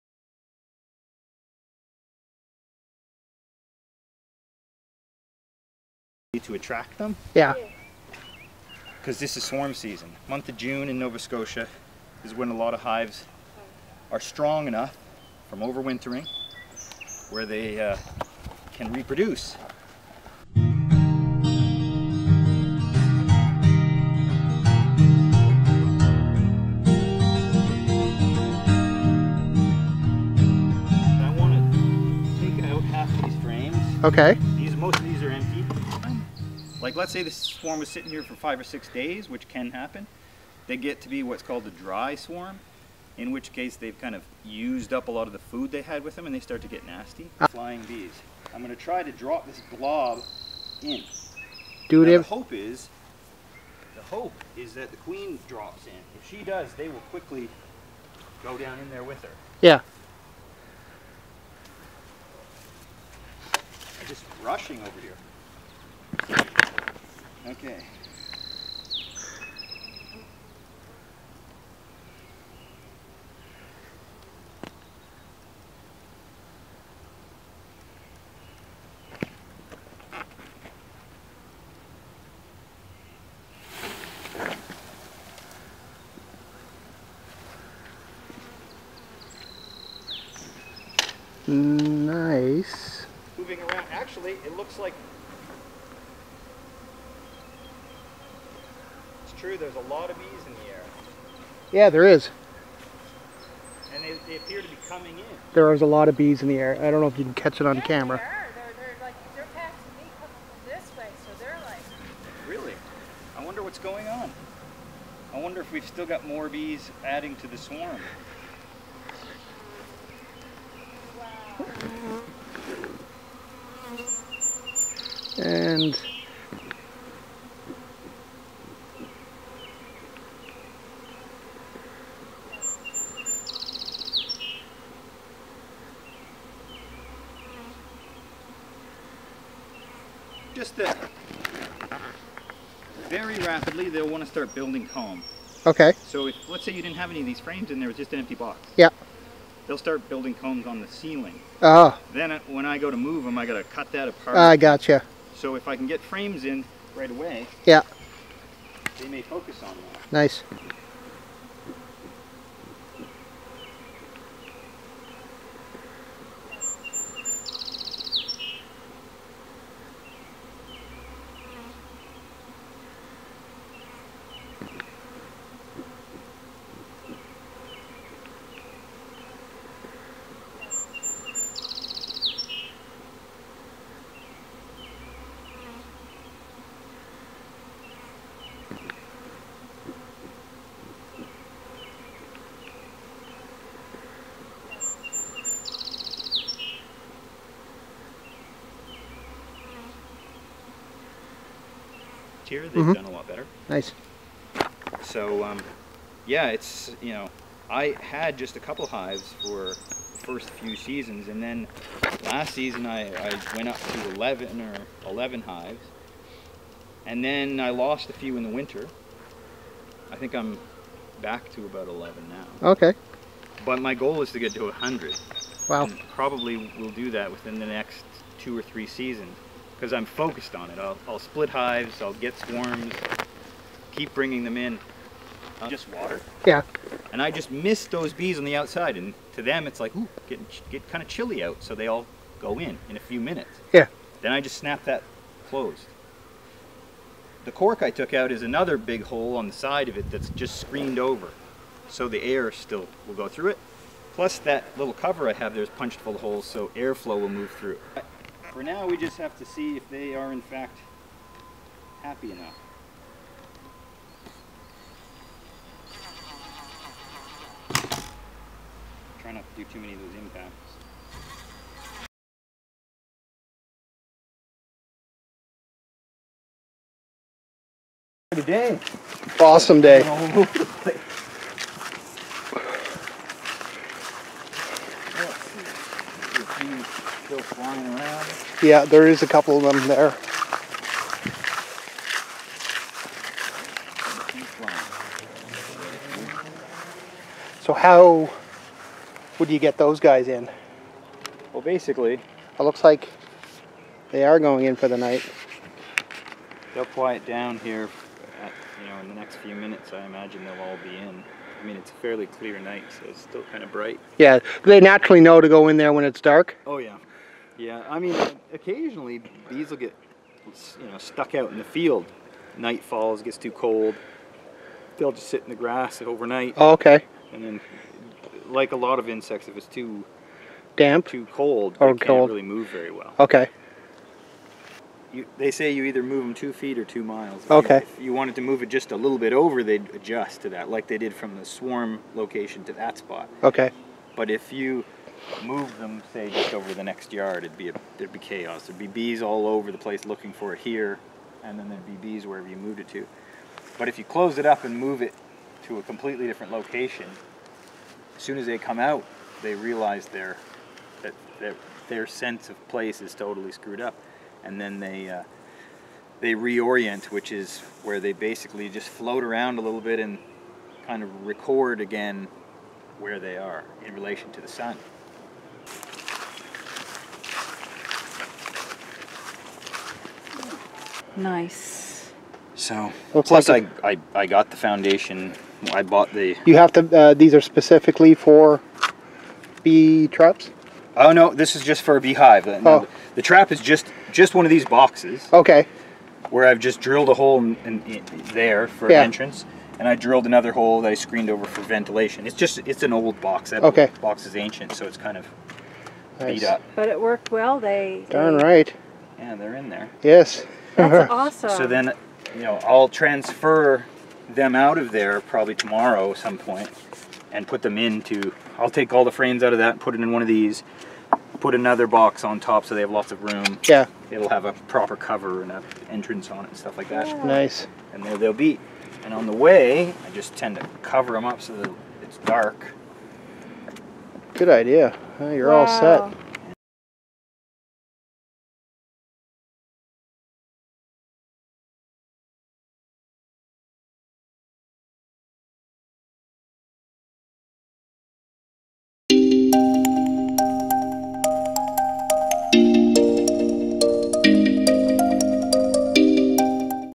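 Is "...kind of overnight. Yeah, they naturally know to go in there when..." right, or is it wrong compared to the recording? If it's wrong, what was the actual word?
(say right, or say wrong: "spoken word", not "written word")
wrong: "bright", not "overnight".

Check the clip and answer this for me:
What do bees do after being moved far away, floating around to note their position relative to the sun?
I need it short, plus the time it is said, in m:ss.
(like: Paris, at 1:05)
reorient, at 6:06.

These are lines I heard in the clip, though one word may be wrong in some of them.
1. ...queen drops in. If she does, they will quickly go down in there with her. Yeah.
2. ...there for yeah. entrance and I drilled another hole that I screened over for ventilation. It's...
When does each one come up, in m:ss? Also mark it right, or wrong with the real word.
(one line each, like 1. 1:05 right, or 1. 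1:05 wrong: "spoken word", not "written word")
1. 0:54 right
2. 6:38 right.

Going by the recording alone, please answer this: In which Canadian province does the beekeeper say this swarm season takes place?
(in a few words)
Nova Scotia.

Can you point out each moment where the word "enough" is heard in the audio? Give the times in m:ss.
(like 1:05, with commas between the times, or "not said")
0:14, 4:22.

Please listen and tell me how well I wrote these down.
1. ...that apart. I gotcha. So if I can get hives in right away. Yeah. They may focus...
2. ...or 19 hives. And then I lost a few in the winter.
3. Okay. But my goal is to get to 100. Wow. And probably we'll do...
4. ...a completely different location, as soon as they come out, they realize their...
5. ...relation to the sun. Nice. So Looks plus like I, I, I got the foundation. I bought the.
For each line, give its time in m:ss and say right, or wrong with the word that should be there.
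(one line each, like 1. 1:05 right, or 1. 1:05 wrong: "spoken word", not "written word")
1. 2:33 wrong: "frames", not "hives"
2. 3:34 wrong: "11", not "19"
3. 3:42 right
4. 5:55 right
5. 6:13 right.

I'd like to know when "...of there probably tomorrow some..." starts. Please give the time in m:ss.
6:54.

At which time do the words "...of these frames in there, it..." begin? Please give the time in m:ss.
2:27.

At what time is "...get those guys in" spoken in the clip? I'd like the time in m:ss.
4:59.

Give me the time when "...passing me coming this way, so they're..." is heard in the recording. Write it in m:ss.
1:49.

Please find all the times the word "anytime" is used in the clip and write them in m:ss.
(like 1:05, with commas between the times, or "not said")
not said.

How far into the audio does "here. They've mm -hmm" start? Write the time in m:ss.
3:22.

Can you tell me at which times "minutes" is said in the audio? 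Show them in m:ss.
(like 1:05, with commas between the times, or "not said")
4:03, 5:09.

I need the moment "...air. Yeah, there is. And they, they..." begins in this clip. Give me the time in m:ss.
1:40.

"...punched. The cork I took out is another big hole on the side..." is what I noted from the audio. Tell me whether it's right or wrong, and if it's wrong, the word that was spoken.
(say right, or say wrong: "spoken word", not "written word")
wrong: "closed", not "punched".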